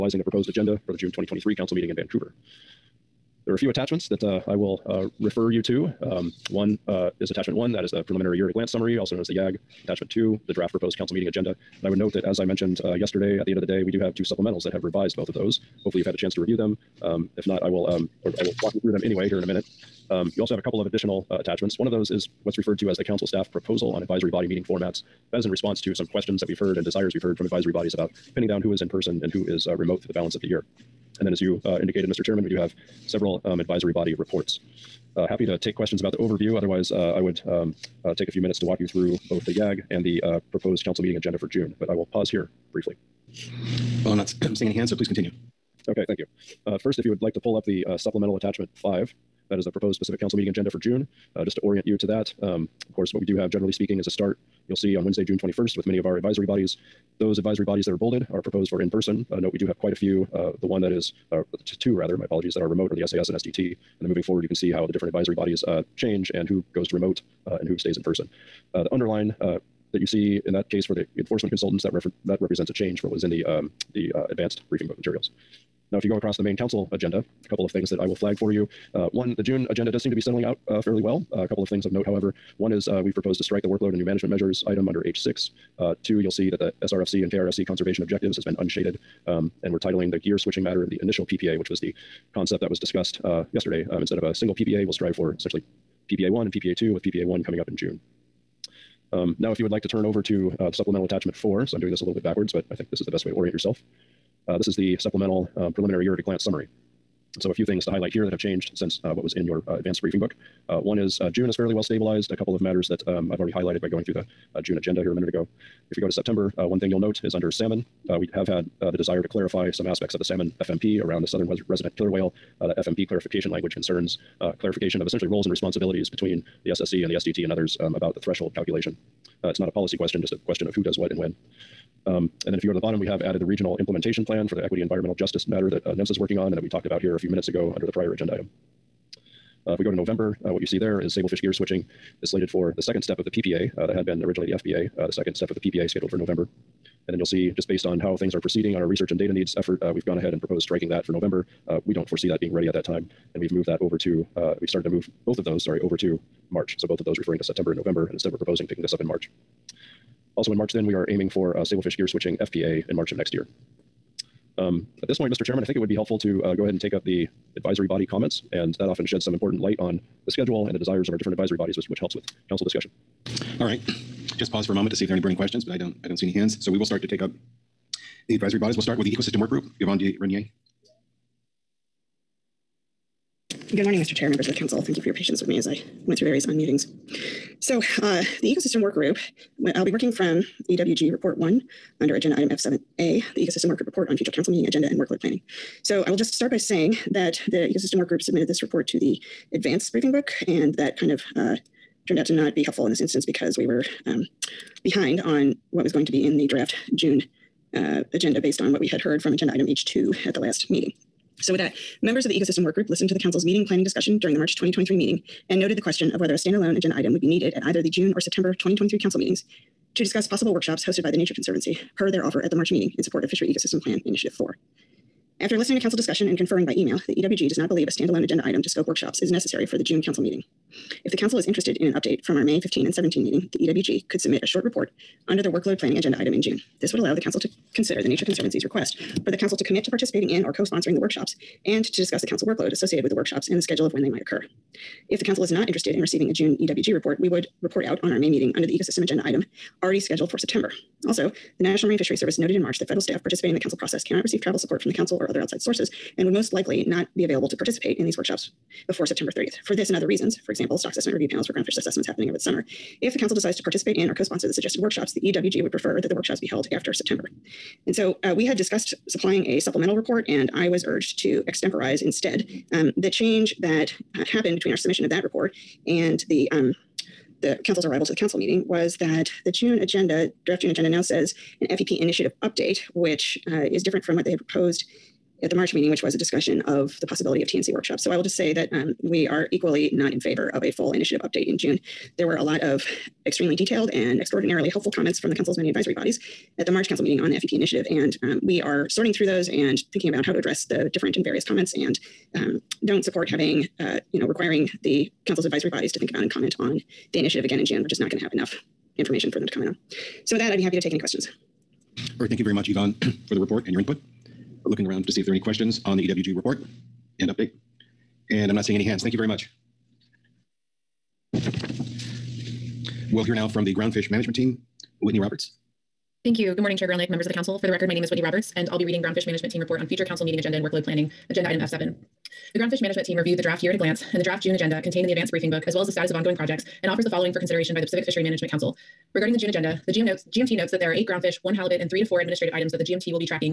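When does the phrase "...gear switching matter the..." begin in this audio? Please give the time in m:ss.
1:30.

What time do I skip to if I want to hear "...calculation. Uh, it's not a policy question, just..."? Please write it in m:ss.
2:08.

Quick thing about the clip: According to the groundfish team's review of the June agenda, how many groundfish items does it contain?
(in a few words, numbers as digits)
8.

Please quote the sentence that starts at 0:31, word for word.
And then, as you uh, indicated, Mr.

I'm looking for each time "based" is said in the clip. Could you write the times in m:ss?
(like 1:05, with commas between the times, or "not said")
2:27, 3:28.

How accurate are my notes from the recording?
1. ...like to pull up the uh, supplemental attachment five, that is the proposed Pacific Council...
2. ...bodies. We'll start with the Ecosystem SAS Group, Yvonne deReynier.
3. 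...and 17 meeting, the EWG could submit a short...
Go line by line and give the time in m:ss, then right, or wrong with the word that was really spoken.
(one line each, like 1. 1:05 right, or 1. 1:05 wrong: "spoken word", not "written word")
1. 0:47 right
2. 2:58 wrong: "Work", not "SAS"
3. 3:52 right.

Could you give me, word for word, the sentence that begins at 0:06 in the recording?
Um, one uh, is attachment one, that is the preliminary year at a glance summary, also known as the YAG.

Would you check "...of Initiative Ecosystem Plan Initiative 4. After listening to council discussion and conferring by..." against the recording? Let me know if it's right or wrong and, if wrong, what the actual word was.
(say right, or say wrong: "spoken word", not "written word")
wrong: "Fishery", not "Initiative".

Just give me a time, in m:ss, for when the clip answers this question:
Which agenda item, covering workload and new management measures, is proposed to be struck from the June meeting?
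1:25.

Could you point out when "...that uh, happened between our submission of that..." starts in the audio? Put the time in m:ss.
4:33.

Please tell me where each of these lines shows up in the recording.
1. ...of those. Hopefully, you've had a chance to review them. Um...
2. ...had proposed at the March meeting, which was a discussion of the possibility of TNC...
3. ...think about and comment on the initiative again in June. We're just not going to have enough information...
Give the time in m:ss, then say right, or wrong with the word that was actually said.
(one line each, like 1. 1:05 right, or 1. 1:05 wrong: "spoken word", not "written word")
1. 0:15 right
2. 4:44 right
3. 5:05 right.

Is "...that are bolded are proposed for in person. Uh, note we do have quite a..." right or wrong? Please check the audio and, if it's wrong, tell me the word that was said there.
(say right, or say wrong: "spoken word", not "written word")
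right.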